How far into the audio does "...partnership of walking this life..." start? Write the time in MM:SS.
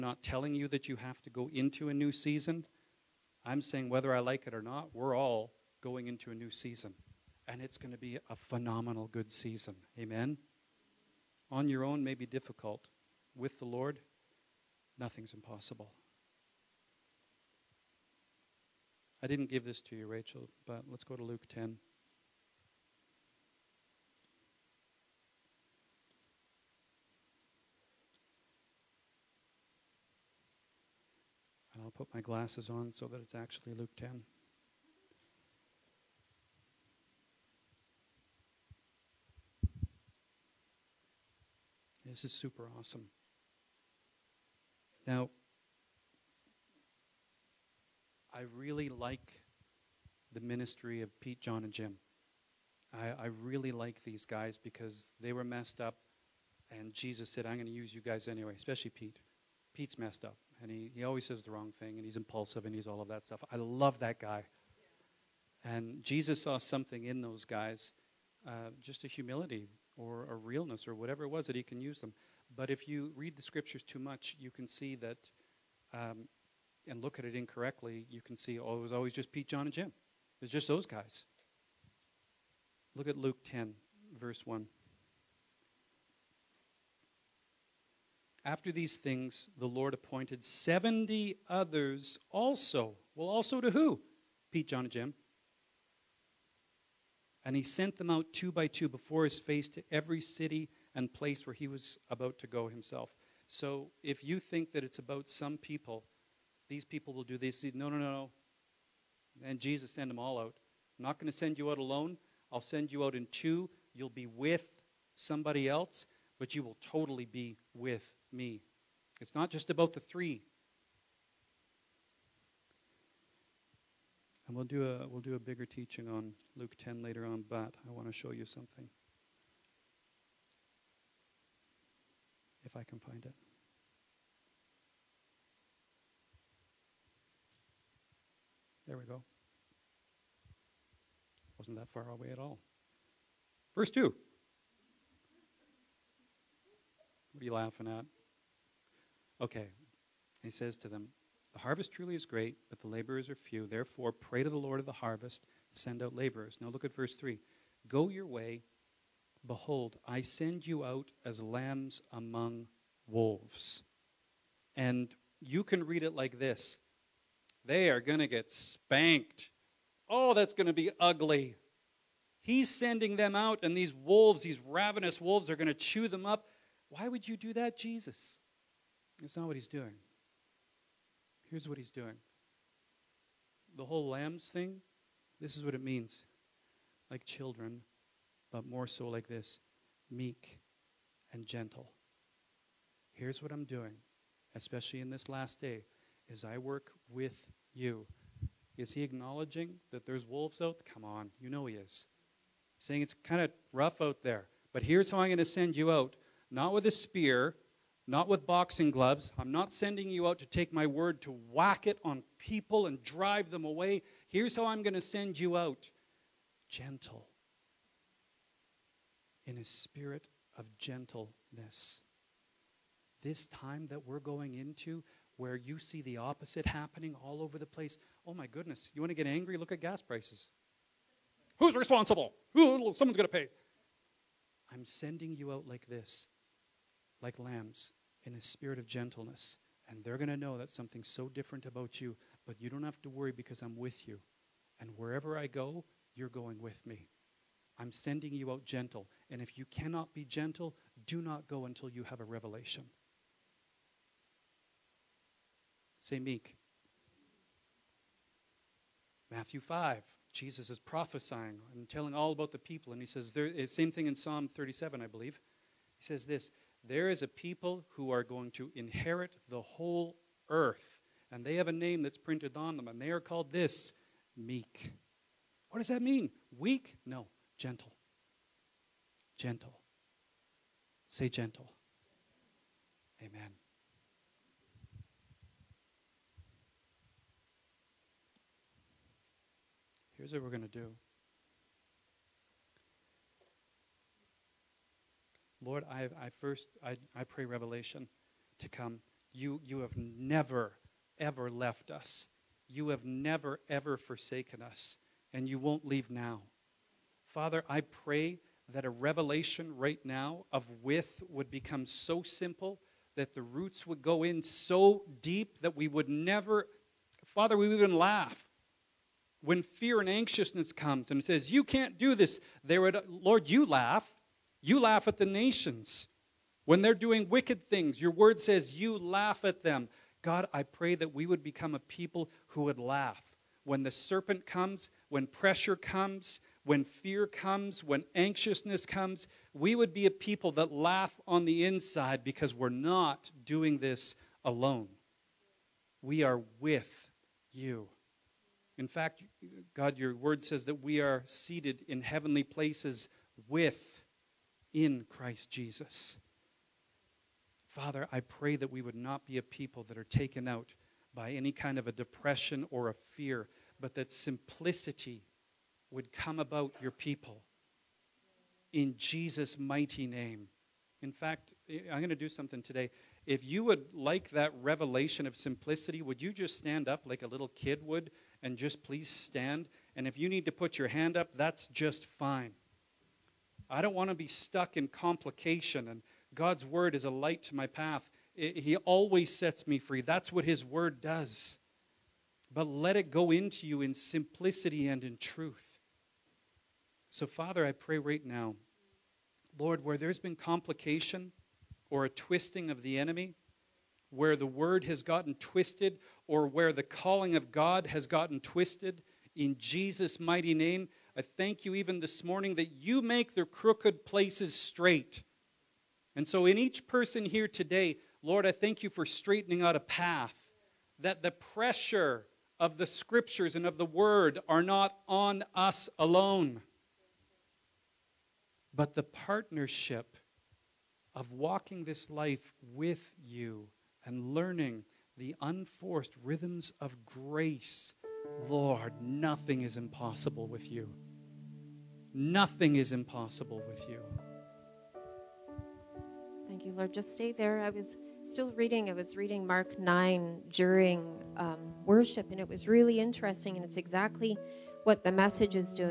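07:09.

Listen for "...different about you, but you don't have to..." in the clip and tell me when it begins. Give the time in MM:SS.
04:01.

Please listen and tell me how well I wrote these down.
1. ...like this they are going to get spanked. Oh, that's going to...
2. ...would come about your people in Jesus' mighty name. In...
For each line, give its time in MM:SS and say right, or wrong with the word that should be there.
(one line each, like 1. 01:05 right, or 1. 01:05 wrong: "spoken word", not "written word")
1. 02:46 right
2. 06:05 right.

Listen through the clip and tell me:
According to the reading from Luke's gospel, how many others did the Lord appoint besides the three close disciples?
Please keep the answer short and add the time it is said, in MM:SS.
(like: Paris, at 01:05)
70, at 01:30.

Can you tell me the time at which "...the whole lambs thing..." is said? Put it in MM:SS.
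03:03.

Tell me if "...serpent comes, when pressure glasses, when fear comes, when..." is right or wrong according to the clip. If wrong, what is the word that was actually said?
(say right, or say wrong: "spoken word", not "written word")
wrong: "comes", not "glasses".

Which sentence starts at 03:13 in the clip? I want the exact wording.
Here's what I'm doing, especially in this last day, is I work with you.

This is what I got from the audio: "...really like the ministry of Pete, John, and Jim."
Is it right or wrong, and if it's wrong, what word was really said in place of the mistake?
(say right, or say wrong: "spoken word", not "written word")
right.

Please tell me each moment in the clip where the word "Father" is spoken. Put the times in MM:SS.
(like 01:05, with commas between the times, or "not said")
05:07, 05:17, 05:57, 06:37.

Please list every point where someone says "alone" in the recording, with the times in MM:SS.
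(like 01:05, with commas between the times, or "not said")
01:51, 05:44, 07:05.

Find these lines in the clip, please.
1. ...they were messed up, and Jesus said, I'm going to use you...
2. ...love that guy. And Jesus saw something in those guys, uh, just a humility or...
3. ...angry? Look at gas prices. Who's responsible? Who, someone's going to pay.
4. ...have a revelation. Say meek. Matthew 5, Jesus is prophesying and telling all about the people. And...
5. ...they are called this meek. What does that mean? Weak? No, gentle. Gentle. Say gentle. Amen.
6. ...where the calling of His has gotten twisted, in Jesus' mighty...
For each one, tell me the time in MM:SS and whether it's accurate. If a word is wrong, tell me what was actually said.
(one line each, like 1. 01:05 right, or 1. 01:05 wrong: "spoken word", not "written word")
1. 00:55 right
2. 01:03 right
3. 03:49 right
4. 04:12 right
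5. 04:33 right
6. 06:46 wrong: "God", not "His".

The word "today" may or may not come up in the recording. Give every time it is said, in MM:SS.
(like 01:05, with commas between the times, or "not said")
06:12, 06:57.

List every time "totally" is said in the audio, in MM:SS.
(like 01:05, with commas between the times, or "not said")
01:56.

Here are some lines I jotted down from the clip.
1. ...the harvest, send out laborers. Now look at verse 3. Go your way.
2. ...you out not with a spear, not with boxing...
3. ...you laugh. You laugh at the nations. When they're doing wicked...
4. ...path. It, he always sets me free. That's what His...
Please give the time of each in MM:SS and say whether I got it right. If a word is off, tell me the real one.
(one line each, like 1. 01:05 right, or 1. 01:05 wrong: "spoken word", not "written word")
1. 02:34 right
2. 03:25 right
3. 05:23 right
4. 06:27 right.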